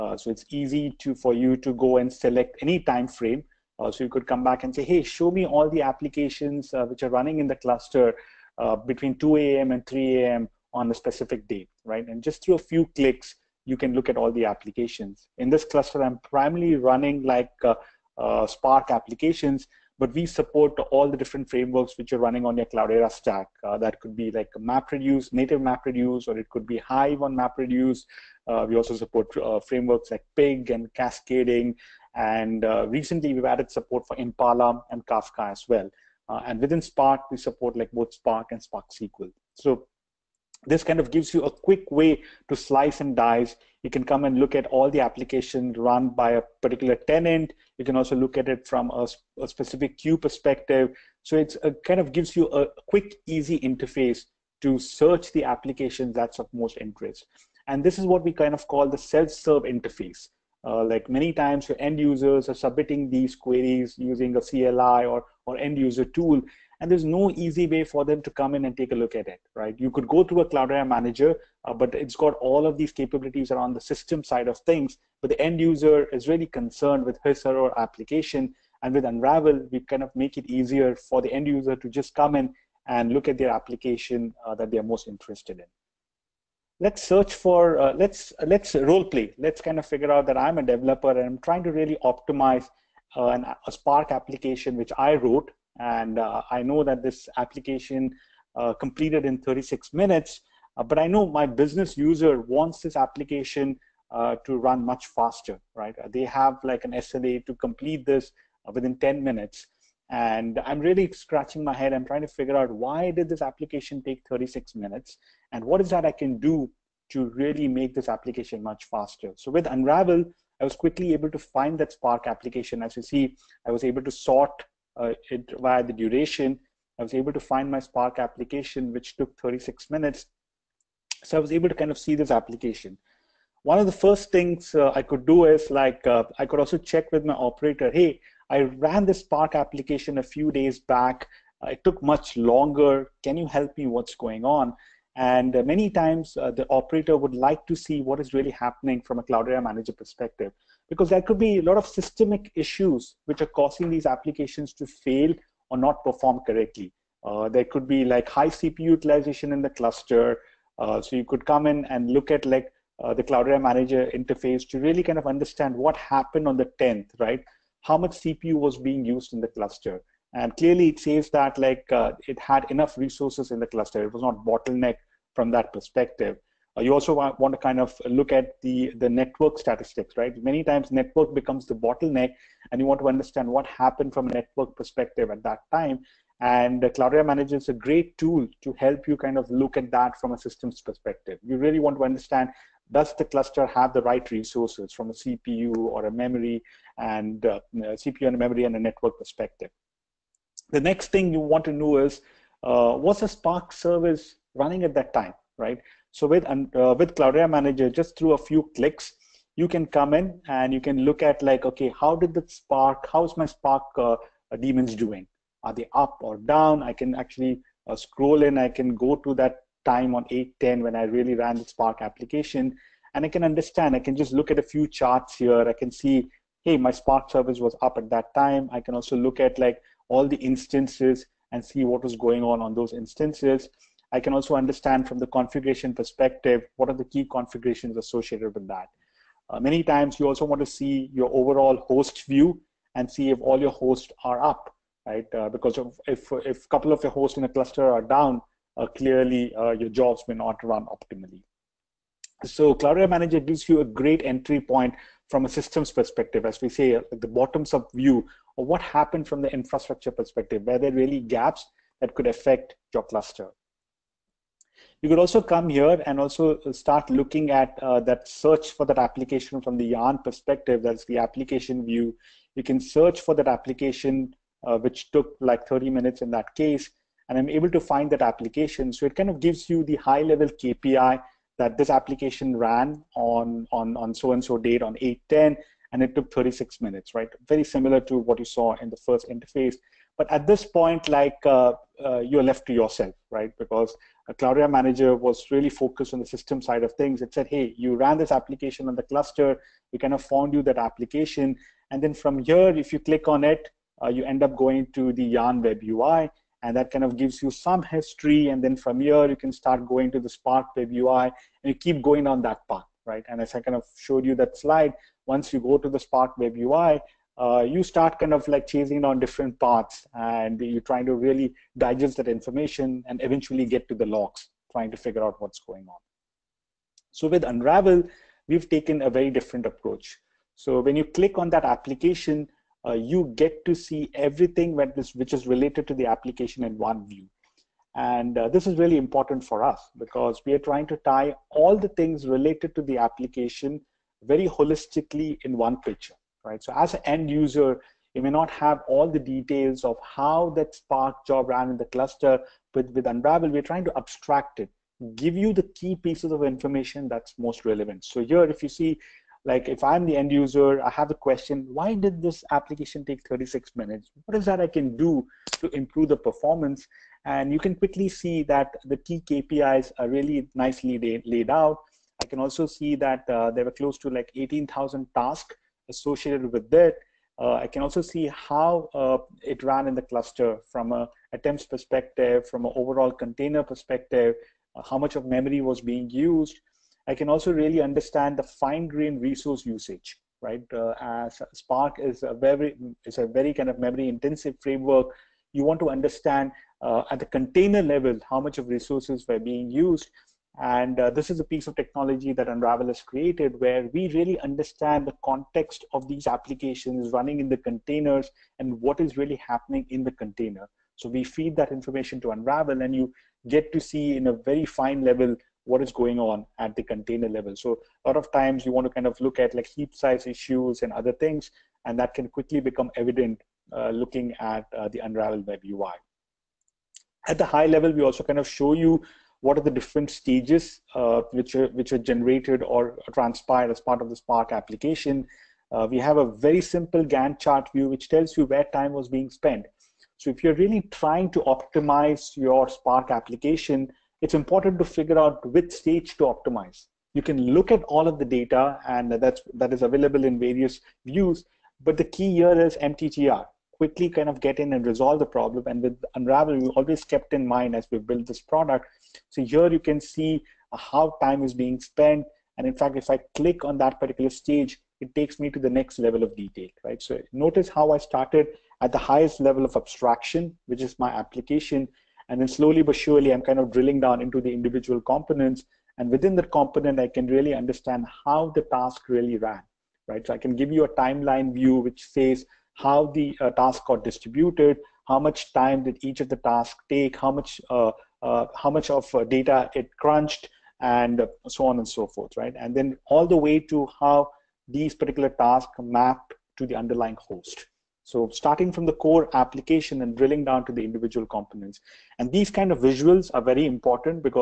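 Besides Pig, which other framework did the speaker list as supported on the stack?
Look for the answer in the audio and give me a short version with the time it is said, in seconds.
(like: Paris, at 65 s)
Cascading, at 30 s.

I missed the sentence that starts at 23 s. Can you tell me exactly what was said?
Uh, that could be like MapReduce, native MapReduce, or it could be Hive on MapReduce.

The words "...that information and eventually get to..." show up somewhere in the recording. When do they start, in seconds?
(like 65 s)
322 s.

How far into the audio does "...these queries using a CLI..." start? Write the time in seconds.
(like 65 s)
63 s.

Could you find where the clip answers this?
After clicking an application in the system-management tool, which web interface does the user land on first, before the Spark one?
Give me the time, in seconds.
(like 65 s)
305 s.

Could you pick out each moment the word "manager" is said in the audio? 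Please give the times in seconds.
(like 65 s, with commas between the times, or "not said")
70 s, 149 s, 163 s, 187 s, 207 s, 253 s, 294 s.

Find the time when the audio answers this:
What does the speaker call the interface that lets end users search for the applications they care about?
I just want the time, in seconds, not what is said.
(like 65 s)
58 s.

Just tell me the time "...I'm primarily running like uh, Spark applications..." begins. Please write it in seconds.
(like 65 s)
16 s.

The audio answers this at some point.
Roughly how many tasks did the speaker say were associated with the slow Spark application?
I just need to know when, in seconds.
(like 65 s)
374 s.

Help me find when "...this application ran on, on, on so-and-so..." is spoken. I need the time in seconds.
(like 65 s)
281 s.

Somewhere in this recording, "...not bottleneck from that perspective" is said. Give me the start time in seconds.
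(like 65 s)
174 s.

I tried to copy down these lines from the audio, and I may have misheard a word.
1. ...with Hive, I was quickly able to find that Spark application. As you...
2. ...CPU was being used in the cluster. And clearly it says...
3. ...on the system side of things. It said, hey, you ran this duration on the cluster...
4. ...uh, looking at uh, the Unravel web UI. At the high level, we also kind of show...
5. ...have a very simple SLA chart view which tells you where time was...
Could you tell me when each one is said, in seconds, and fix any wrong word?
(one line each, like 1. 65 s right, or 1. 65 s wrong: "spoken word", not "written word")
1. 119 s wrong: "Unravel", not "Hive"
2. 168 s right
3. 296 s wrong: "application", not "duration"
4. 423 s right
5. 435 s wrong: "Gantt", not "SLA".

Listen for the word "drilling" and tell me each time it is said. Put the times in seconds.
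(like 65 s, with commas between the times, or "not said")
473 s, 500 s.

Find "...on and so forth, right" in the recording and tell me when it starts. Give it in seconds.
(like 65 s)
491 s.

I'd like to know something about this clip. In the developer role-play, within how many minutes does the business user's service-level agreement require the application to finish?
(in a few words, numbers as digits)
10 minutes.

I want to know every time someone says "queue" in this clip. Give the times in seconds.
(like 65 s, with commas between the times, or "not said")
49 s.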